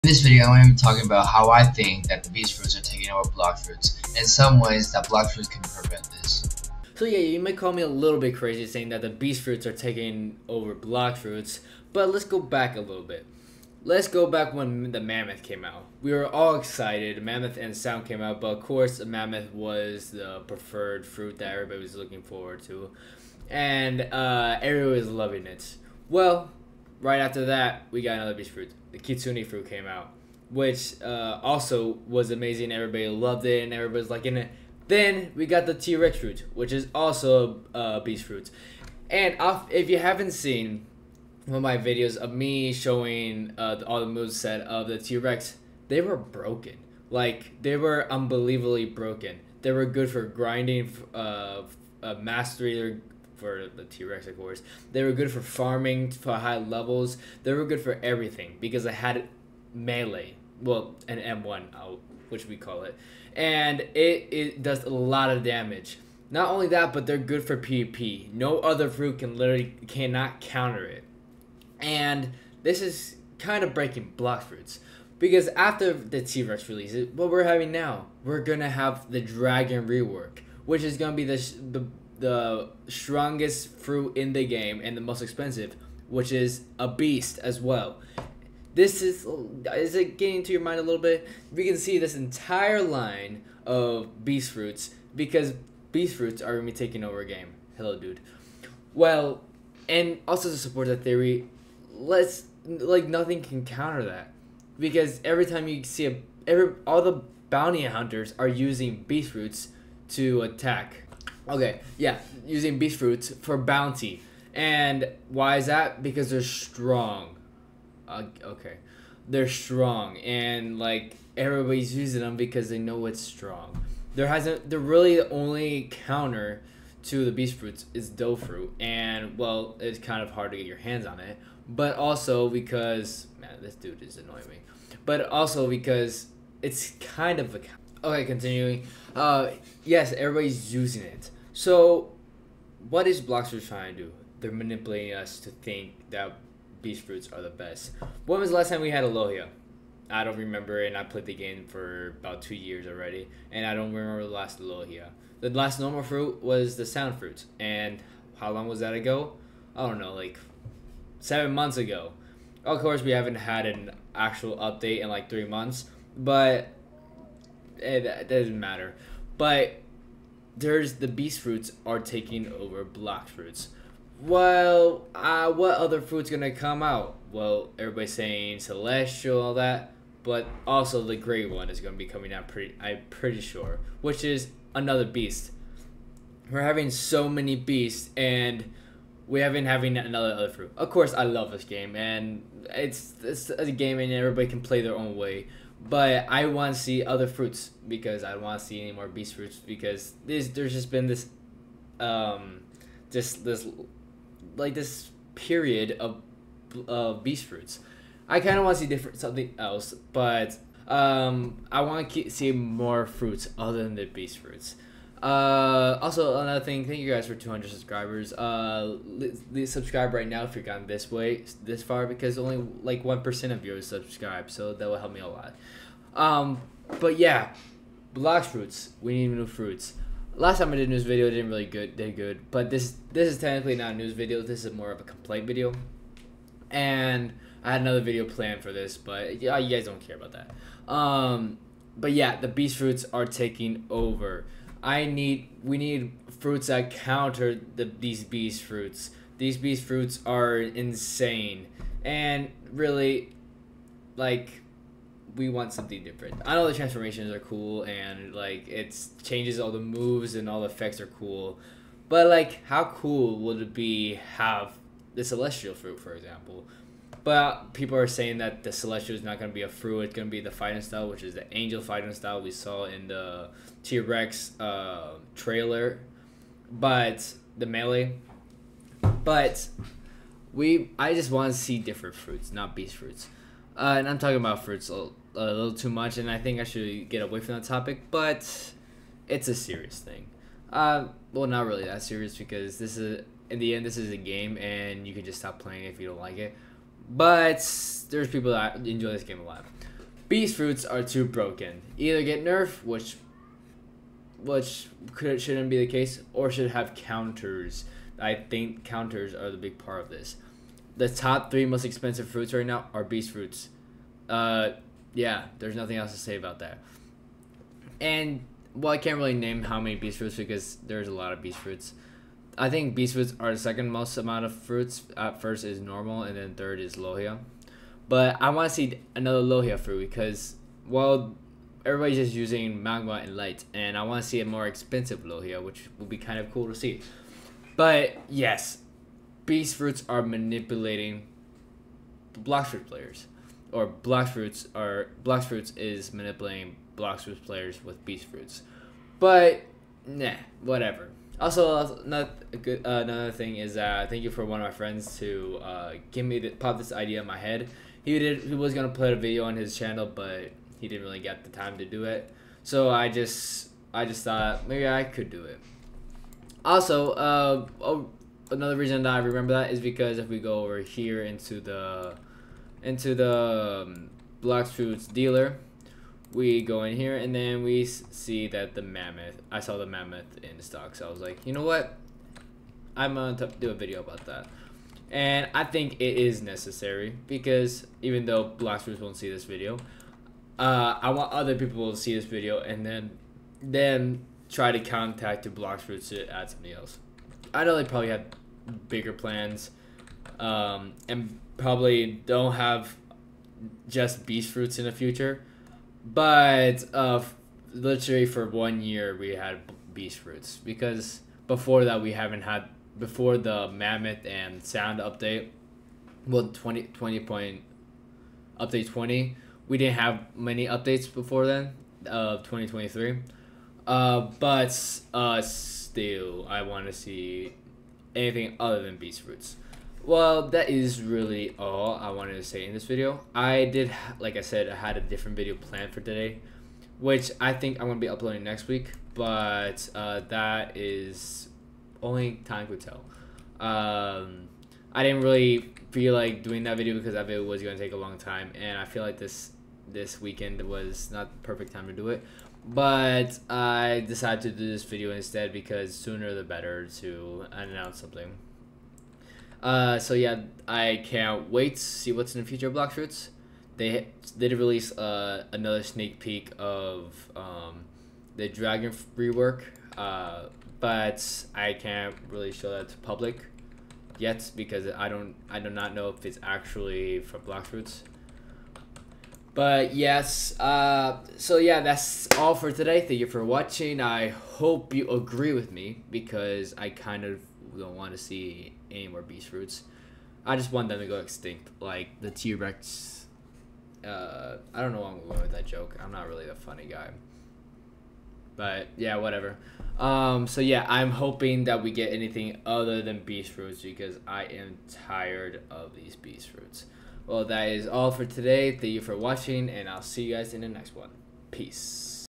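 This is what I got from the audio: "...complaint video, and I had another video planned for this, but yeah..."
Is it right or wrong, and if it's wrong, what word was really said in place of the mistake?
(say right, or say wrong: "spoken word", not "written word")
right.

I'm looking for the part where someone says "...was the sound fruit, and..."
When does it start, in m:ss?
2:36.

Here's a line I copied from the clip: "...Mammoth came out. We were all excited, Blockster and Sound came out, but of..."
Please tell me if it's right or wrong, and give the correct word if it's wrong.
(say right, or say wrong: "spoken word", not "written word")
wrong: "Mammoth", not "Blockster".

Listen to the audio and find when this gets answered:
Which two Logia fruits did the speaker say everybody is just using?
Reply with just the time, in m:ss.
5:32.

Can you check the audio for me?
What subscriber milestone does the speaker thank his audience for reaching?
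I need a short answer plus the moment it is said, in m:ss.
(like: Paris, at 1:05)
200, at 3:37.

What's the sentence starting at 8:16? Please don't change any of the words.
I'm not really the funny guy.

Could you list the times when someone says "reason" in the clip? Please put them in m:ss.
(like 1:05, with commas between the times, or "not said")
6:08.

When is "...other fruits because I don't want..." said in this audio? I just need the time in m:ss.
3:17.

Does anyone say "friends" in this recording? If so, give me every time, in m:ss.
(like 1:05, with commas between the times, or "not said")
5:54.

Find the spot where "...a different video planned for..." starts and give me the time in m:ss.
7:14.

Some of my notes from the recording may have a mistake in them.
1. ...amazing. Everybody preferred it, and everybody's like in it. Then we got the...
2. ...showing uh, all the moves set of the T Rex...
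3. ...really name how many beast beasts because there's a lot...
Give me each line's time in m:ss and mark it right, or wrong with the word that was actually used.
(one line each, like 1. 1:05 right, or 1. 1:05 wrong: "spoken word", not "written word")
1. 0:32 wrong: "loved", not "preferred"
2. 0:42 right
3. 5:19 wrong: "fruits", not "beasts".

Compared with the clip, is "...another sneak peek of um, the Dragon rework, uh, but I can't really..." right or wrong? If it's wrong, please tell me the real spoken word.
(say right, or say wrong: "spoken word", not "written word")
right.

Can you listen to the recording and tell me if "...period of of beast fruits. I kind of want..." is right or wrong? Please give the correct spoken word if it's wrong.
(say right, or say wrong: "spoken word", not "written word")
right.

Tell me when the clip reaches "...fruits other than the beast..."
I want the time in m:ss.
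3:33.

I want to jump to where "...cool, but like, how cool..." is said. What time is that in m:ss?
4:21.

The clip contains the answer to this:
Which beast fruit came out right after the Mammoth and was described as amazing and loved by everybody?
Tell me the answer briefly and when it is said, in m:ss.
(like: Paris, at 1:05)
Kitsune, at 0:28.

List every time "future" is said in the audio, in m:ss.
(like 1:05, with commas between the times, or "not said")
6:44, 7:42.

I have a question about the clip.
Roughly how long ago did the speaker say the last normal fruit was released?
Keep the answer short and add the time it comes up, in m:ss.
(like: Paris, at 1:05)
7 months, at 2:41.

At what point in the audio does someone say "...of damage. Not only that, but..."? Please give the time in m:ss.
1:05.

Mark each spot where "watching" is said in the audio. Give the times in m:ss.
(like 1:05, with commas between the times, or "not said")
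8:03, 8:29.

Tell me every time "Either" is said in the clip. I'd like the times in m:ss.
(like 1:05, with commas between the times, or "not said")
5:01.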